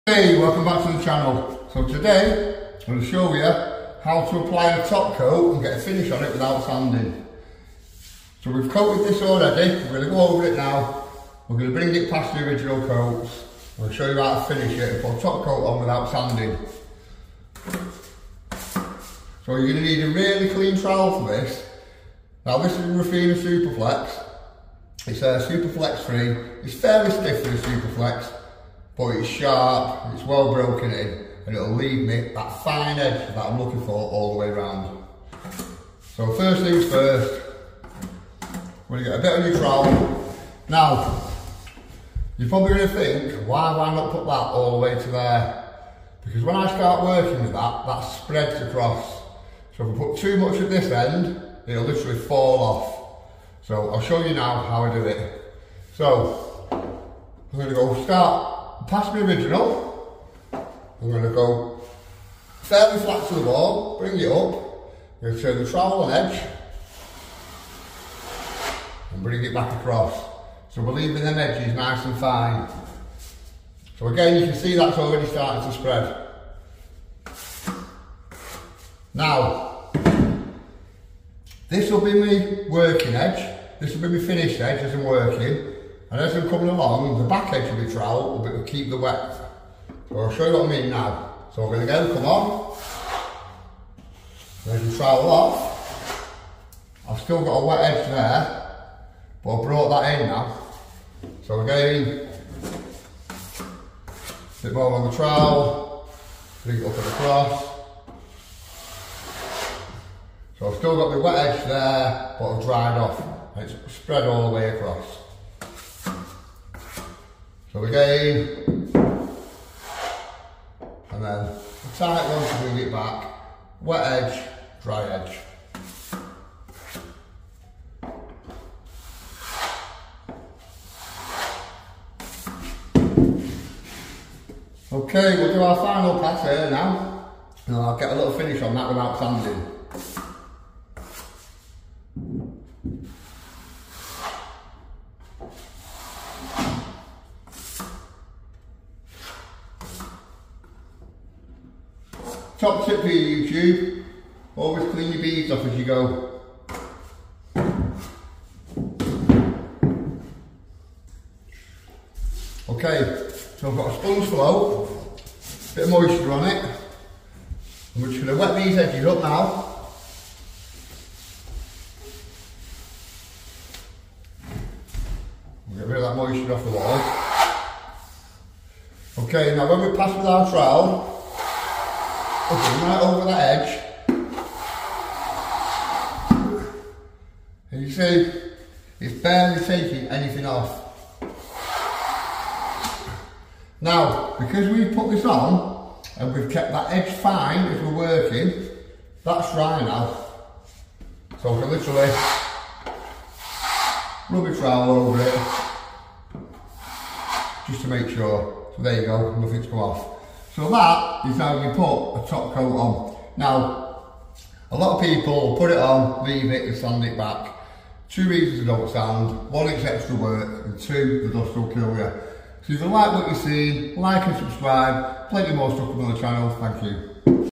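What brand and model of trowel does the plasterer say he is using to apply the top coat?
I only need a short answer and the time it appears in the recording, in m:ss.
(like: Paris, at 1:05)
Refina Superflex, at 0:22.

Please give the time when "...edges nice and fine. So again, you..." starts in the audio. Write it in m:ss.
1:11.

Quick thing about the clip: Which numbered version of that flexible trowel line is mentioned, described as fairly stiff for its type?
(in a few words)
3.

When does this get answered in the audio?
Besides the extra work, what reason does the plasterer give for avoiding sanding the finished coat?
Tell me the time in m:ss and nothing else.
3:41.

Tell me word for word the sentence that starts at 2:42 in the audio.
Okay, so I've got a sponge flow, a bit of moisture on it.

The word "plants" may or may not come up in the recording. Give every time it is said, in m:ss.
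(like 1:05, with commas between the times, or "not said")
not said.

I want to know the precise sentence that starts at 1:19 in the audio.
Now, this will be my working edge.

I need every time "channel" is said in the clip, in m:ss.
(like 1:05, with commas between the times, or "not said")
0:01, 3:46.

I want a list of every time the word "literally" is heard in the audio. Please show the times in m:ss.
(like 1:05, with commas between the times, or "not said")
0:51, 3:21.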